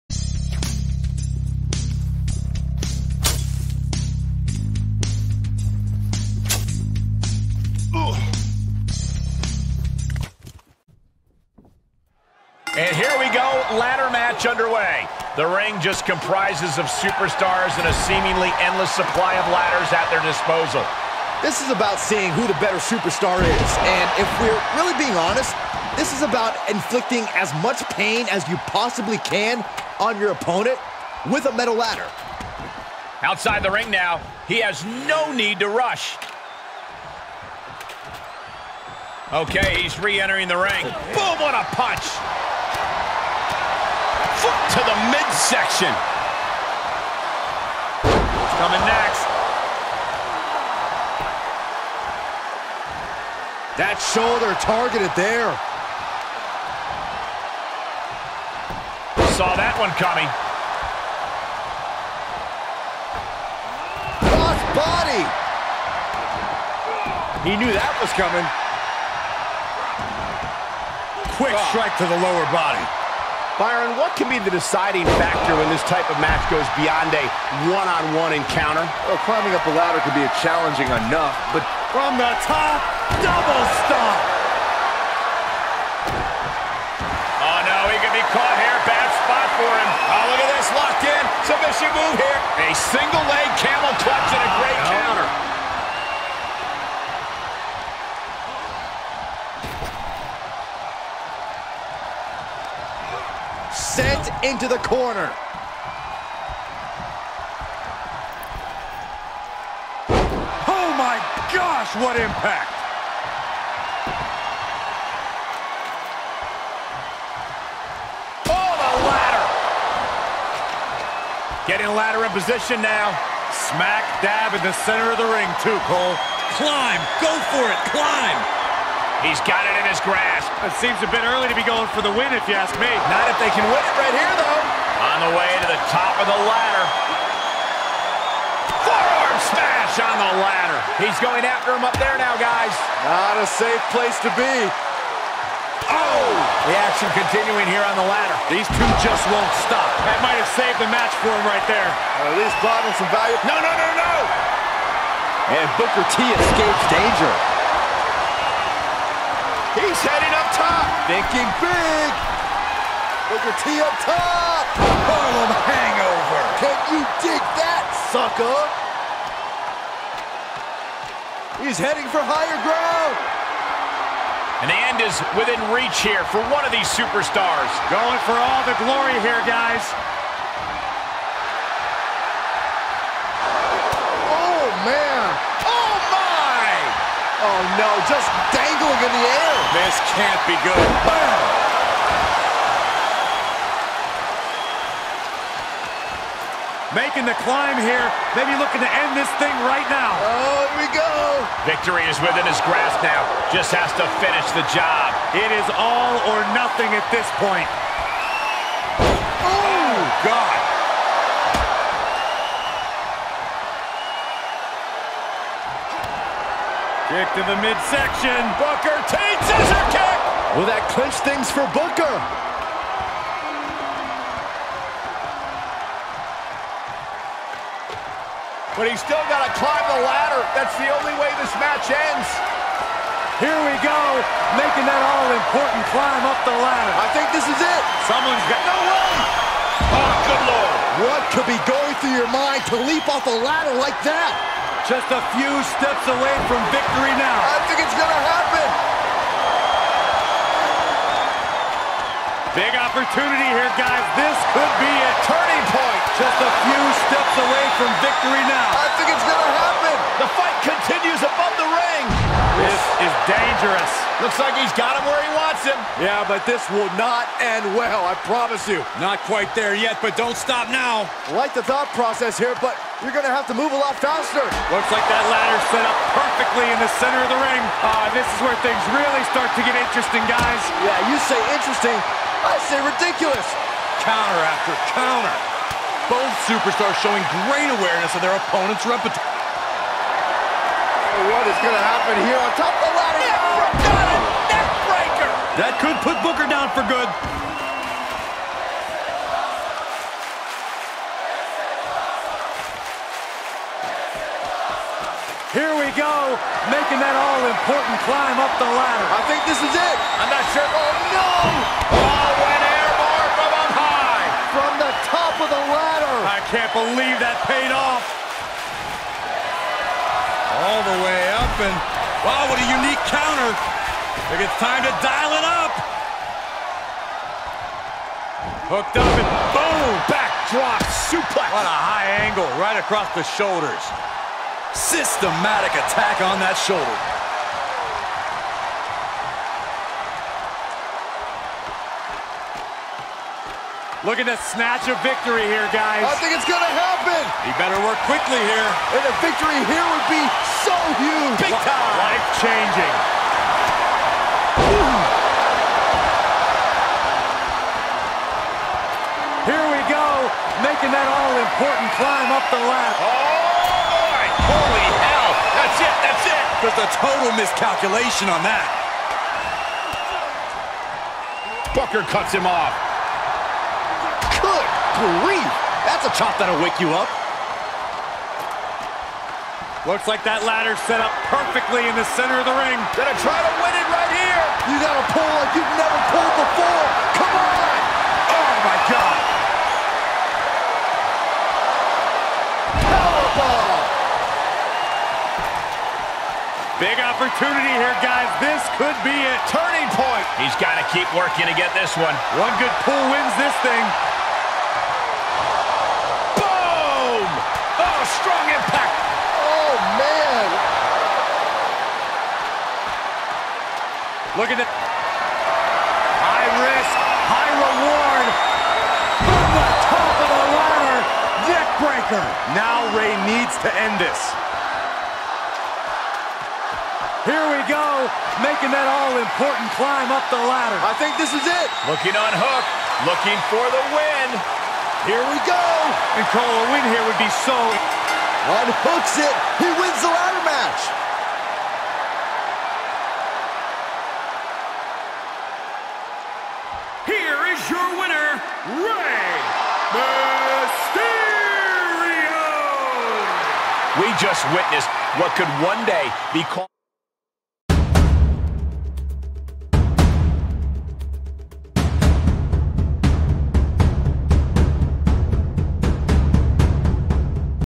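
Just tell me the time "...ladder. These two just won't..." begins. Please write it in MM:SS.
02:28.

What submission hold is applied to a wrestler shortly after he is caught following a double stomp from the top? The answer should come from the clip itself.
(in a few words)
Single leg camel clutch.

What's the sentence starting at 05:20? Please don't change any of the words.
All the way up, and wow, what a unique counter.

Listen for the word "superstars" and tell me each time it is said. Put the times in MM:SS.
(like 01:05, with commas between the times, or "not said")
00:16, 00:22, 02:56, 04:46.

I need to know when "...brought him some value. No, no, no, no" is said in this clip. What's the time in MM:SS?
02:32.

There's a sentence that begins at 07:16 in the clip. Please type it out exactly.
And Cole, a win here would be so...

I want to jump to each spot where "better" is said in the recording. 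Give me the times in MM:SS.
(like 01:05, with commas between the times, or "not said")
00:22, 05:47.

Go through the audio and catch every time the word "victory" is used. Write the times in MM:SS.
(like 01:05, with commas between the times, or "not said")
03:21, 04:06, 04:18, 05:45, 05:49.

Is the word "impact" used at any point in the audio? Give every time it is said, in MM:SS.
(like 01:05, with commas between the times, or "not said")
01:52, 06:48.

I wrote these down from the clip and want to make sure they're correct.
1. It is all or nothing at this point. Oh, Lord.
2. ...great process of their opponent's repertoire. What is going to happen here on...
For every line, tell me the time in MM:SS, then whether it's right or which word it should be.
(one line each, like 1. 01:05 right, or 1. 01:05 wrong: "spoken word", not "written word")
1. 03:25 wrong: "God", not "Lord"
2. 04:47 wrong: "awareness", not "process".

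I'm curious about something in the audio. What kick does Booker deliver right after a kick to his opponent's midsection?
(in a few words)
Scissor kick.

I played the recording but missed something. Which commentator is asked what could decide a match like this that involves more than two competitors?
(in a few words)
Byron.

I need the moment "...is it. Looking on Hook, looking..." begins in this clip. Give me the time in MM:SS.
07:11.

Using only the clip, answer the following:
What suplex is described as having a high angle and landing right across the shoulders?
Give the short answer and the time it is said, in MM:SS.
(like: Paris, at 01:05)
Backdrop suplex, at 05:30.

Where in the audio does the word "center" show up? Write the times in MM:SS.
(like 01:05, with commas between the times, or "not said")
02:04, 04:37, 06:22.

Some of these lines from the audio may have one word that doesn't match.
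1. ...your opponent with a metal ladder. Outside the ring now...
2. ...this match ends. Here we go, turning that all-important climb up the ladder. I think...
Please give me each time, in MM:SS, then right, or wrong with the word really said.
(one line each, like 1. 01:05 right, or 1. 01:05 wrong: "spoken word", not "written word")
1. 00:30 right
2. 03:51 wrong: "making", not "turning".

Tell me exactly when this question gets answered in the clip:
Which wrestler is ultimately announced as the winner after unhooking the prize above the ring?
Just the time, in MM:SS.
07:28.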